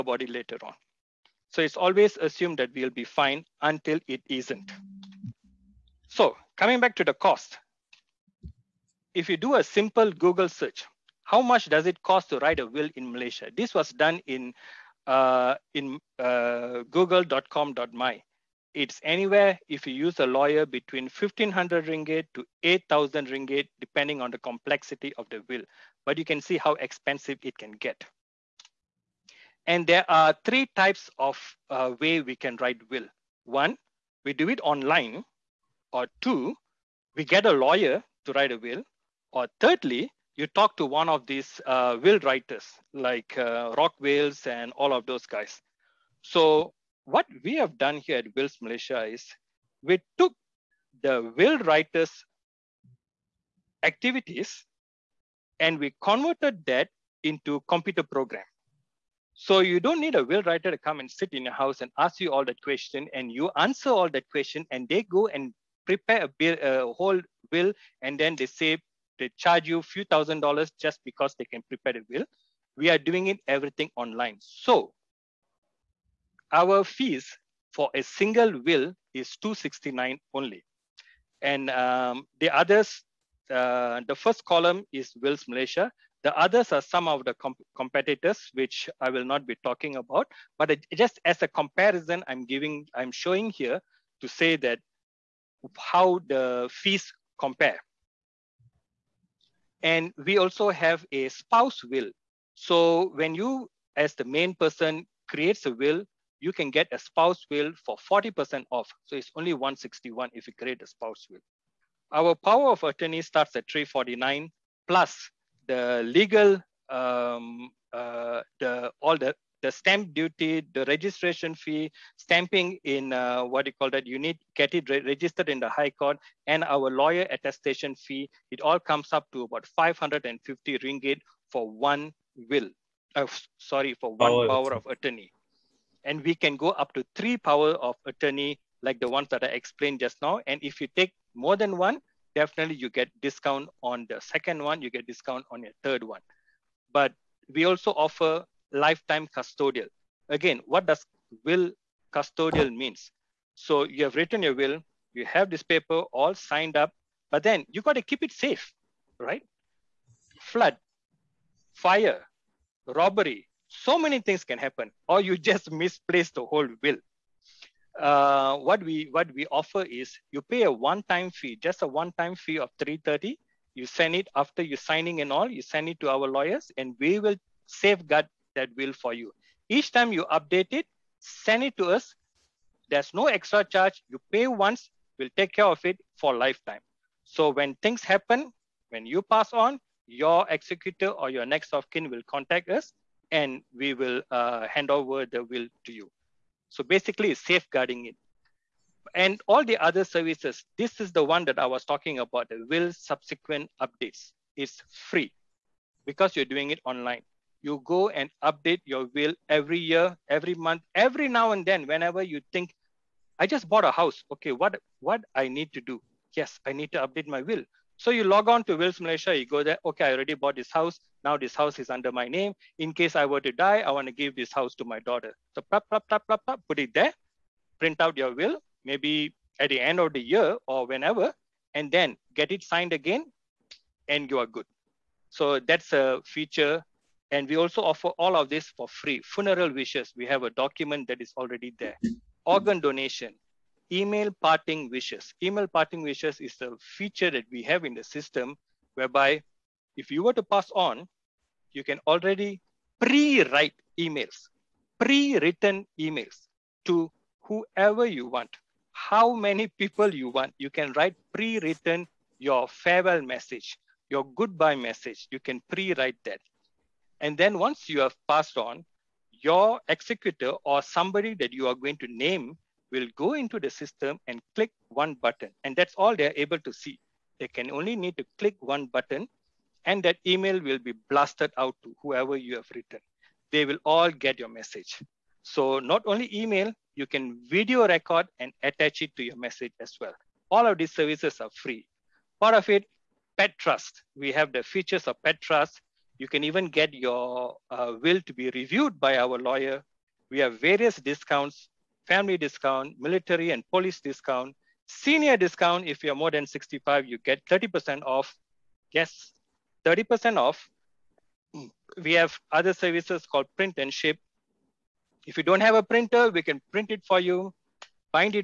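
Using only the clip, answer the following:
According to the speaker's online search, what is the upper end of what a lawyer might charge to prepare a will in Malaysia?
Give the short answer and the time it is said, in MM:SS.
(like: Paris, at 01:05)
8000 ringgit, at 00:22.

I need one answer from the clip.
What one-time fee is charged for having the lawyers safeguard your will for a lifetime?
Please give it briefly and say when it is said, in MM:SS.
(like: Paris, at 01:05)
330, at 02:52.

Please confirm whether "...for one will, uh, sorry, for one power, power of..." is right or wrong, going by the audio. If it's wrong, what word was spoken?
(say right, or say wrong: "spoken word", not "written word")
right.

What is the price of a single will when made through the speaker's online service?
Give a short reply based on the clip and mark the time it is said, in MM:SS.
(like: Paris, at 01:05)
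269, at 01:19.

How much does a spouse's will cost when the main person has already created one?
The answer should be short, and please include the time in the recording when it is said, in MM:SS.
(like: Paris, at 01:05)
161, at 01:49.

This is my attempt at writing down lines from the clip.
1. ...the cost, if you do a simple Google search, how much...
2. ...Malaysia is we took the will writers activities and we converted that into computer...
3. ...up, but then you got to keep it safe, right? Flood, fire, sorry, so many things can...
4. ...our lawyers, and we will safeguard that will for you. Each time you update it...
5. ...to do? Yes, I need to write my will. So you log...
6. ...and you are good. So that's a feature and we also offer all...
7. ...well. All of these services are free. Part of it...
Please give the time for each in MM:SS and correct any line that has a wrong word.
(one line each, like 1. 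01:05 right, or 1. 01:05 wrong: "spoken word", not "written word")
1. 00:07 right
2. 00:48 right
3. 02:36 wrong: "robbery", not "sorry"
4. 02:56 right
5. 03:35 wrong: "update", not "write"
6. 03:54 right
7. 04:50 right.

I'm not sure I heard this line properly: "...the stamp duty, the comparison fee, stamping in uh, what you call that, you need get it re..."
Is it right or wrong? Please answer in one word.
wrong.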